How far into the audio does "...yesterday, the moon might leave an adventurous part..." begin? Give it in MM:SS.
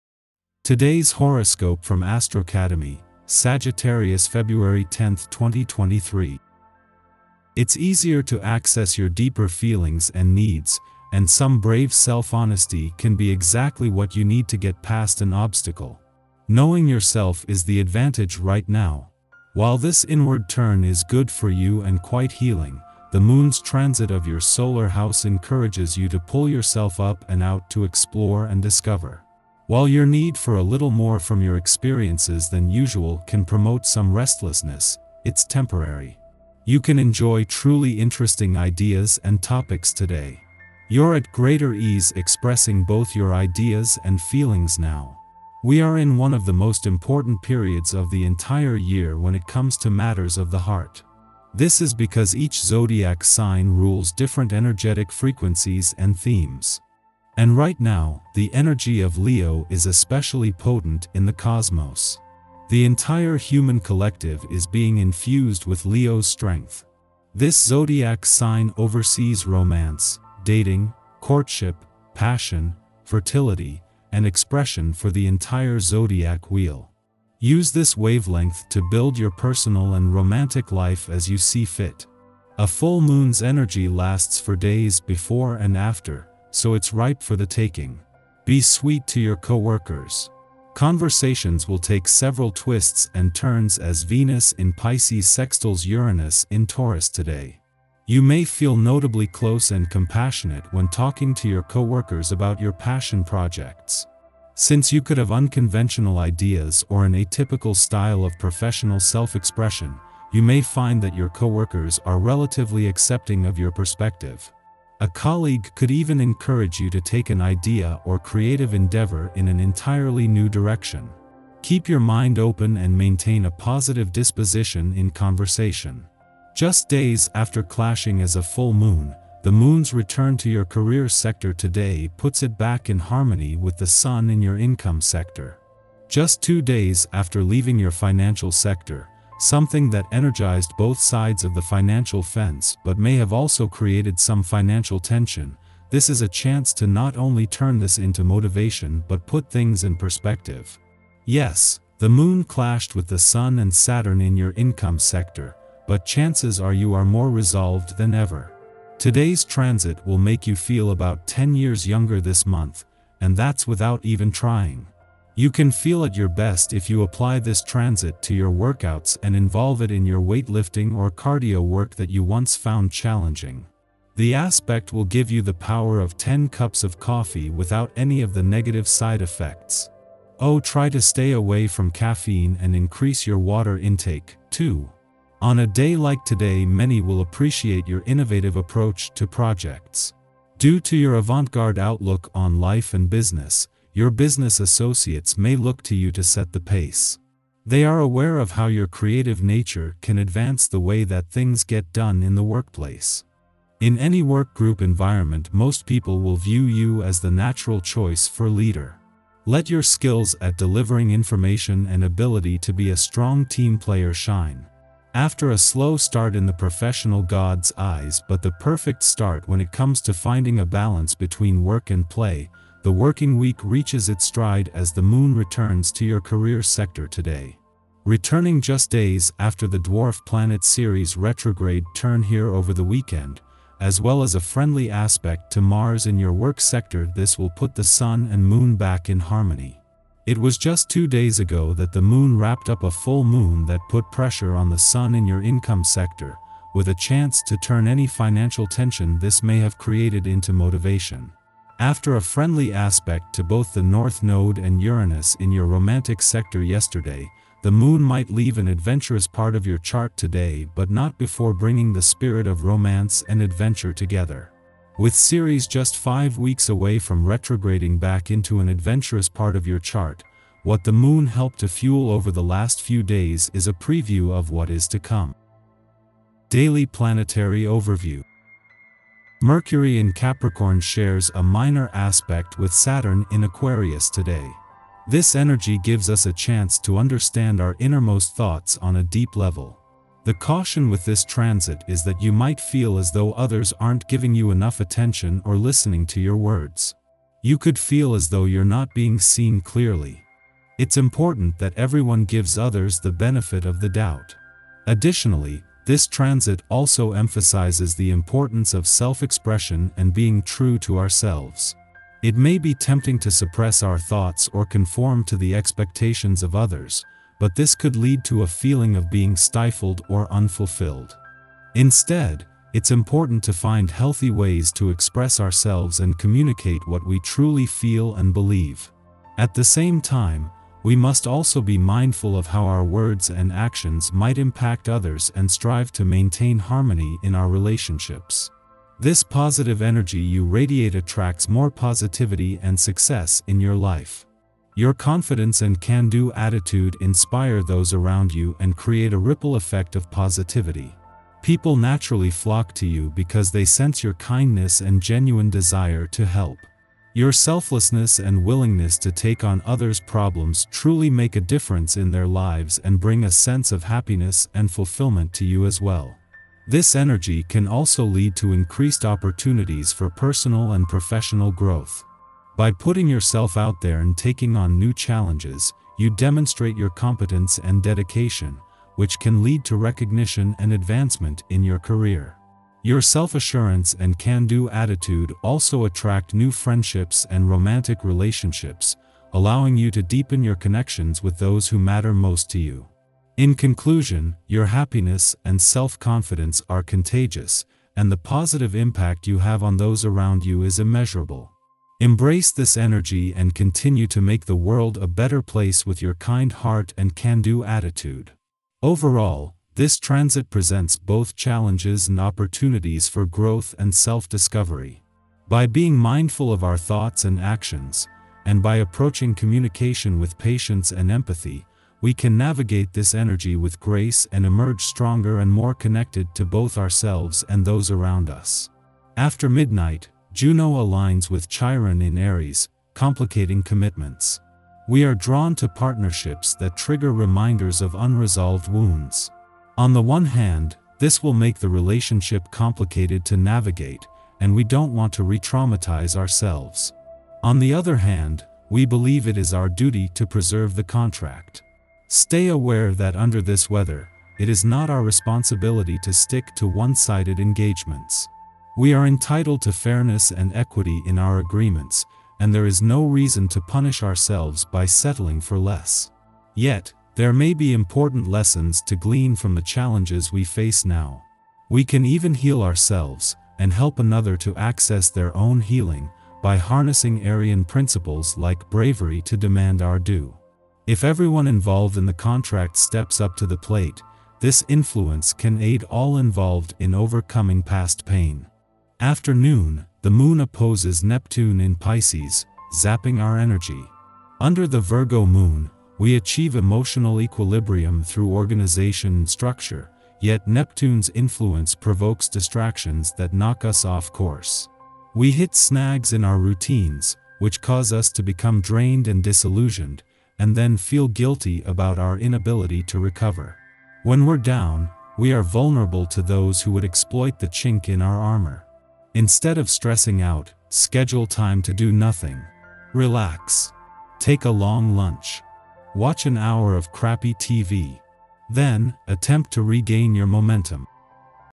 04:16.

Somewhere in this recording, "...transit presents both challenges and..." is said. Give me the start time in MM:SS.
06:49.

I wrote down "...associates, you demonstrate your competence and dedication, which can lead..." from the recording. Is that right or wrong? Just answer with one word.
wrong.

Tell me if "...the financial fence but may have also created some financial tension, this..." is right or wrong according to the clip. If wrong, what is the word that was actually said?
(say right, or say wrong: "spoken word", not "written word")
right.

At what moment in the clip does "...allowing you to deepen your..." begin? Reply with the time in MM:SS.
06:29.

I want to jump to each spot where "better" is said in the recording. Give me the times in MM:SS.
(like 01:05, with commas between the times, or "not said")
06:45.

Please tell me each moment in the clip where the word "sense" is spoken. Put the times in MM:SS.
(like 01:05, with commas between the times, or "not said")
05:53, 06:03.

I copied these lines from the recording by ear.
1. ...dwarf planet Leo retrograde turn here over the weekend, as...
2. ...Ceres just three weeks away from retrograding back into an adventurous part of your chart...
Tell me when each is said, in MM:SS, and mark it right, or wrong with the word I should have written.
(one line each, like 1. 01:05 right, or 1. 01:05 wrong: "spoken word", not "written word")
1. 03:49 wrong: "Ceres", not "Leo"
2. 04:25 wrong: "five", not "three".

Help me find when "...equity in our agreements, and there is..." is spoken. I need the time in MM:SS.
07:40.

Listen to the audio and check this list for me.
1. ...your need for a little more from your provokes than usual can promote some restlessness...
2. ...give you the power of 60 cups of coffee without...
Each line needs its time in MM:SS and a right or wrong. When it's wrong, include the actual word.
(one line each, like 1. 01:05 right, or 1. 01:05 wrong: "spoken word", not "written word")
1. 00:29 wrong: "experiences", not "provokes"
2. 02:55 wrong: "10", not "60".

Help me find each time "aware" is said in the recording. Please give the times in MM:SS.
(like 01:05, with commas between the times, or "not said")
03:17, 07:32.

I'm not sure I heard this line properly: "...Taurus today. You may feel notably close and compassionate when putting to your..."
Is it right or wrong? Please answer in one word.
wrong.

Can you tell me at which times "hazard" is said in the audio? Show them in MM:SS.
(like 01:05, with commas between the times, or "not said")
not said.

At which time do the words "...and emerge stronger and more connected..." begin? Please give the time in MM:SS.
07:04.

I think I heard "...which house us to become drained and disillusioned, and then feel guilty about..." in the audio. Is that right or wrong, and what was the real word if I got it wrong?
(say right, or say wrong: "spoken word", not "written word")
wrong: "cause", not "house".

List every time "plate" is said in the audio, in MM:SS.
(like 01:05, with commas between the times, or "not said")
08:03.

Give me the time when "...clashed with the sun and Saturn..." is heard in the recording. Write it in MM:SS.
02:32.